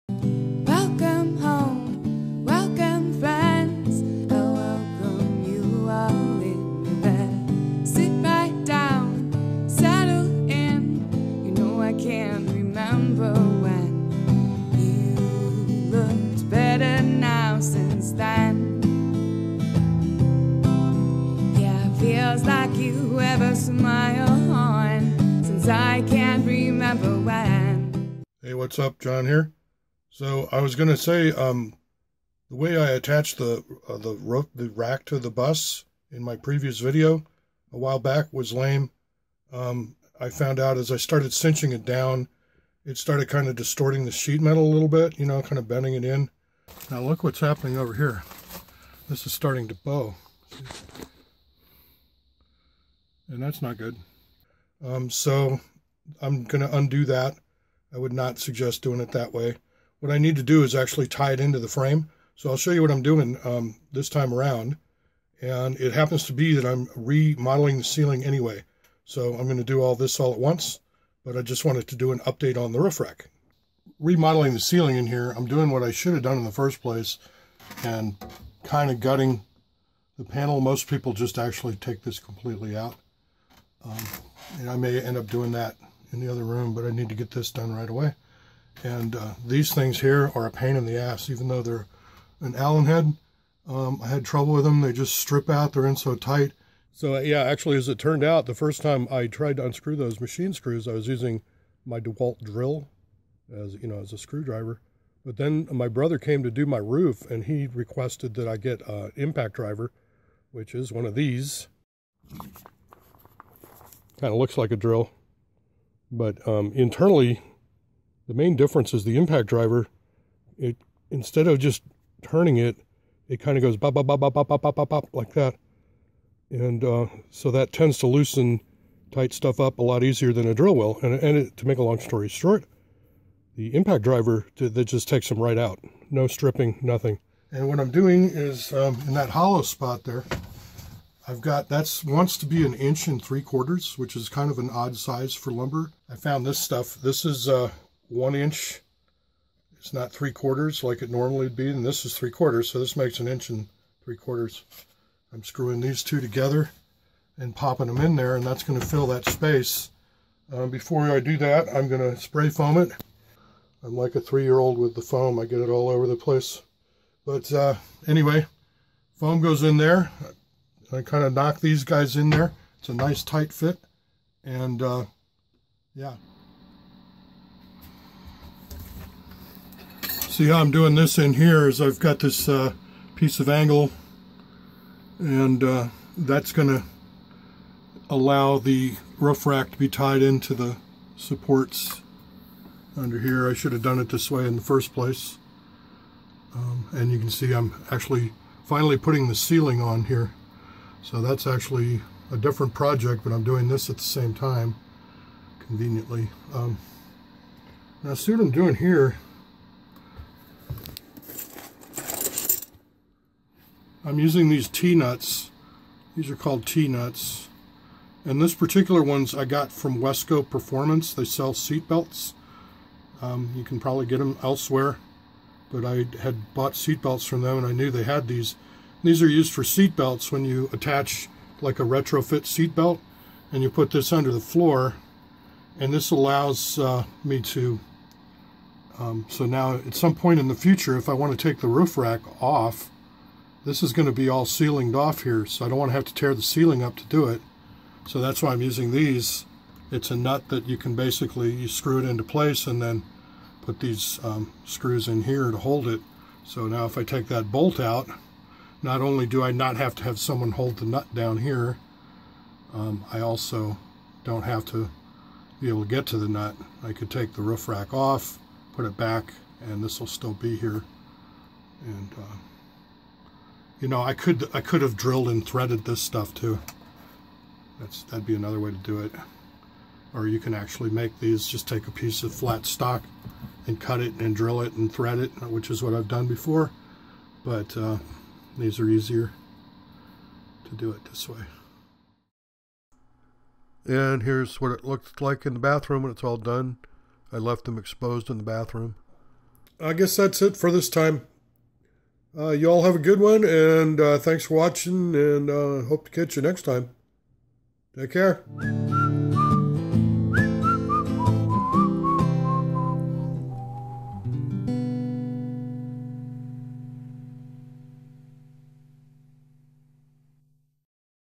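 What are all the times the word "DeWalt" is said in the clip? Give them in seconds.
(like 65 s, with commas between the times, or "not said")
101 s.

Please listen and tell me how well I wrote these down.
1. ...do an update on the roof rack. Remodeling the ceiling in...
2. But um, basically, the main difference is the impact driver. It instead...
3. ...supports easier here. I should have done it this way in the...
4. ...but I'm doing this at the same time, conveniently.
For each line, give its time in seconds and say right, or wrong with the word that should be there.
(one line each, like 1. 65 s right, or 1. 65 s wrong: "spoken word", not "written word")
1. 71 s right
2. 116 s wrong: "internally", not "basically"
3. 191 s wrong: "under", not "easier"
4. 203 s right.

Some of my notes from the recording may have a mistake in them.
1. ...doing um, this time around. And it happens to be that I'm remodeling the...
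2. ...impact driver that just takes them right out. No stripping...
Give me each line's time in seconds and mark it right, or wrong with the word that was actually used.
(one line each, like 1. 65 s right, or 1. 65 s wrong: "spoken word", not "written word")
1. 63 s right
2. 133 s right.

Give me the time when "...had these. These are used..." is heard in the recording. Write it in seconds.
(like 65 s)
228 s.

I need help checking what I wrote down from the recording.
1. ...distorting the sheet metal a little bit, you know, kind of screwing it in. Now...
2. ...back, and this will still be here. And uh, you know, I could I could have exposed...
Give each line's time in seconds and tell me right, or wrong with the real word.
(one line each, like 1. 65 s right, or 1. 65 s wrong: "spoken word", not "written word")
1. 43 s wrong: "bending", not "screwing"
2. 268 s wrong: "drilled", not "exposed".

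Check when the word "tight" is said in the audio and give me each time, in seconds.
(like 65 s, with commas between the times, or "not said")
96 s, 129 s, 173 s.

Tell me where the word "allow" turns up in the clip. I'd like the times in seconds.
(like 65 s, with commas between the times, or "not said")
188 s, 236 s.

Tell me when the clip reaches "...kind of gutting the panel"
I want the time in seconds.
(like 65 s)
78 s.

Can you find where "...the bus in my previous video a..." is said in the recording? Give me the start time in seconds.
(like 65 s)
35 s.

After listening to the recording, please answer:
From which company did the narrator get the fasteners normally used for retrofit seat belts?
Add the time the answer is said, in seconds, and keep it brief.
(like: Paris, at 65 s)
Wesco Performance, at 219 s.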